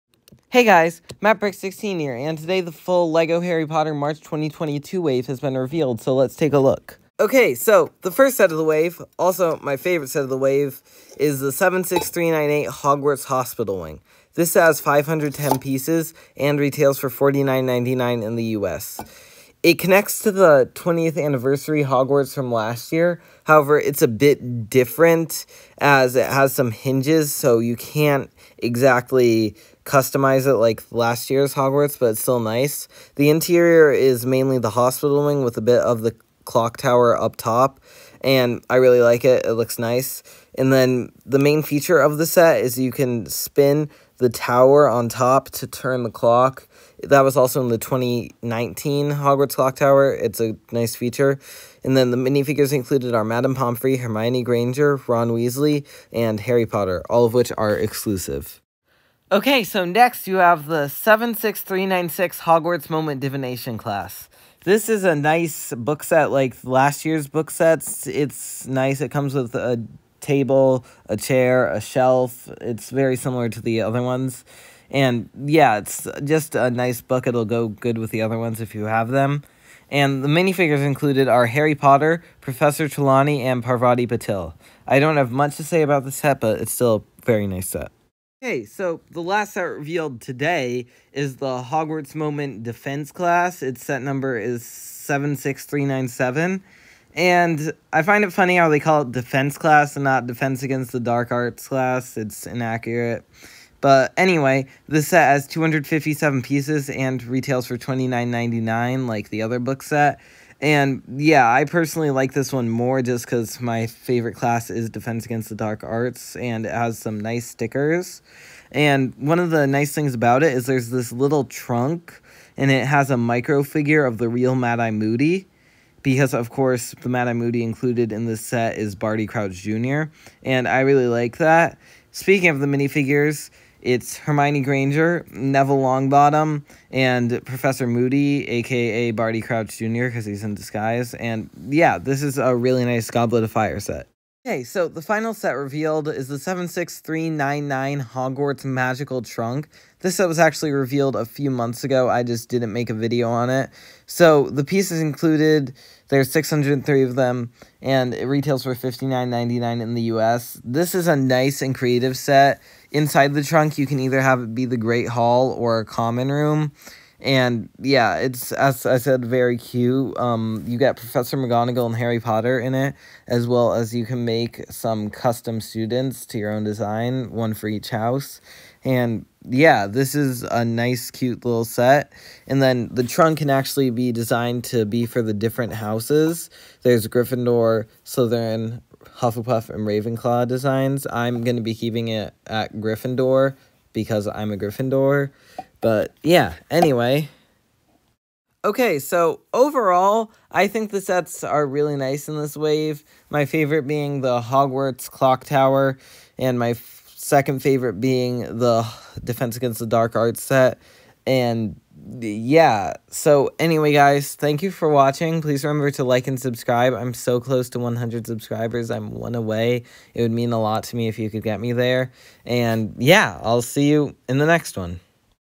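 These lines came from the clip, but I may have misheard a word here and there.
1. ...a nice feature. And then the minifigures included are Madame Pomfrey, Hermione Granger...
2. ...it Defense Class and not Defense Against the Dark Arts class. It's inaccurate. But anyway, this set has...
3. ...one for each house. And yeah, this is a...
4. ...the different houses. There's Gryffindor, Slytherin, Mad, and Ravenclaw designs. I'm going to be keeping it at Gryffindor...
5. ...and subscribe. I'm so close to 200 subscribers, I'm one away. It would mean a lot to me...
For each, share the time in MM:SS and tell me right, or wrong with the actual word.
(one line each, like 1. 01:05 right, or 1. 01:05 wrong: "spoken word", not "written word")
1. 00:50 right
2. 01:39 right
3. 02:57 right
4. 03:05 wrong: "Hufflepuff", not "Mad"
5. 03:36 wrong: "100", not "200".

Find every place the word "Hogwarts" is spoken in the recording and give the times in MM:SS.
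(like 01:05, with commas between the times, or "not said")
00:12, 00:21, 00:31, 00:49, 01:02, 01:31, 02:28, 03:24.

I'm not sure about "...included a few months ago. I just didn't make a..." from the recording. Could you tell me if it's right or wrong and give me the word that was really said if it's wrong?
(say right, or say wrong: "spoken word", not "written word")
wrong: "revealed", not "included".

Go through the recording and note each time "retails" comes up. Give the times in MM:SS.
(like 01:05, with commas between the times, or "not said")
00:16, 01:47, 02:38.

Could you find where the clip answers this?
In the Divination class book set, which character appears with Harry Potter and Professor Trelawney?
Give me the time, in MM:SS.
01:23.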